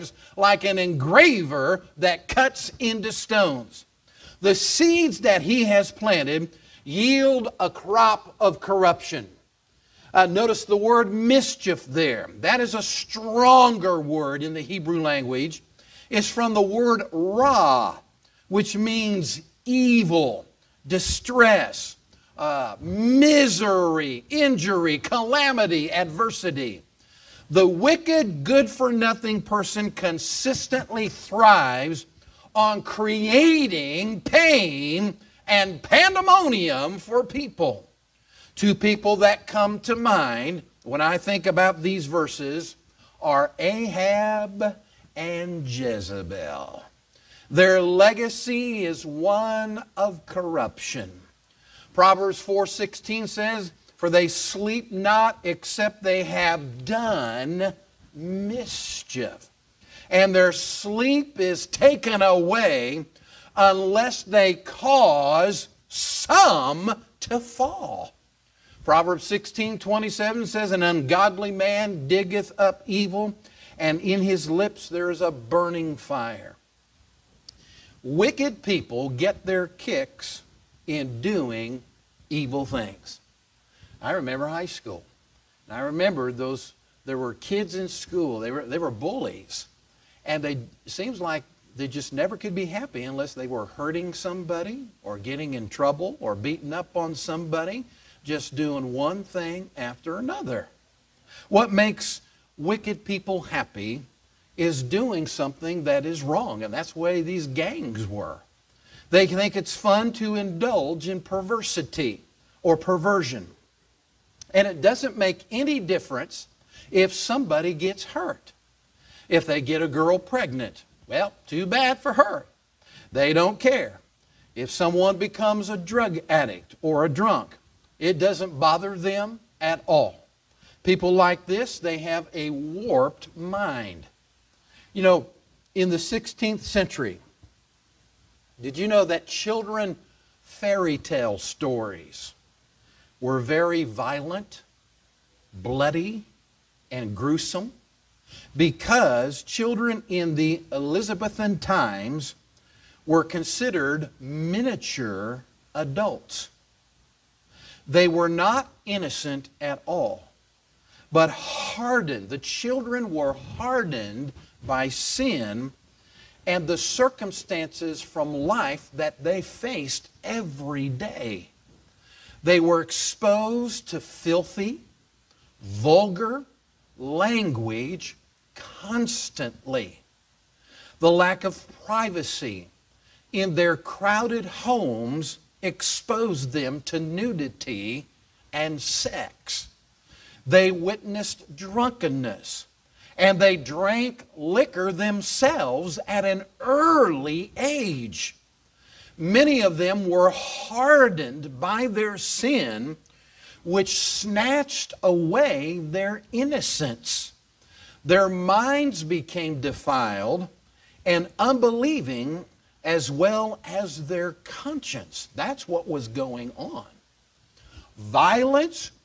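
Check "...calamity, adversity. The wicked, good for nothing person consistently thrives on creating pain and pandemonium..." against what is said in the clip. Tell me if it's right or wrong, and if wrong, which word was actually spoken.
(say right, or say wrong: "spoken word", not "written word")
right.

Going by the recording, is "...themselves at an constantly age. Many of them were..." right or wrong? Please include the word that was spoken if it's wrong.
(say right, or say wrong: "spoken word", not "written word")
wrong: "early", not "constantly".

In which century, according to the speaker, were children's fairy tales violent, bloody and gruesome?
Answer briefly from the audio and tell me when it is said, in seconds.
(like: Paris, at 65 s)
16th century, at 135 s.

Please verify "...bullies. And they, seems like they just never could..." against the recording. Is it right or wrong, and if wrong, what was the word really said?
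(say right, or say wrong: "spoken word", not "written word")
right.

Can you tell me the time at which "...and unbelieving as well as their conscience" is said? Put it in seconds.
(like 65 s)
211 s.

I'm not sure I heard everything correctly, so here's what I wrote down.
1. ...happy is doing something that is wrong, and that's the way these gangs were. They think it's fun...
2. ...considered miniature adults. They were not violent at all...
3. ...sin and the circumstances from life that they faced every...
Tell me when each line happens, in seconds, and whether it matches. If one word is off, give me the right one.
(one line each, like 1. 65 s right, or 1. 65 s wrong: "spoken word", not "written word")
1. 103 s right
2. 153 s wrong: "innocent", not "violent"
3. 164 s right.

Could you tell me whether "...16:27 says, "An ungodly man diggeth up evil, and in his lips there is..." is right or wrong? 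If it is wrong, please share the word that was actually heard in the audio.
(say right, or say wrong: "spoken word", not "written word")
right.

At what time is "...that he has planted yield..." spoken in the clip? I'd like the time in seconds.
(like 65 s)
5 s.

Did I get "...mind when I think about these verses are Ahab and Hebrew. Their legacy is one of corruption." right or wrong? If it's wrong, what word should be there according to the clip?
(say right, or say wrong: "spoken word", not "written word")
wrong: "Jezebel", not "Hebrew".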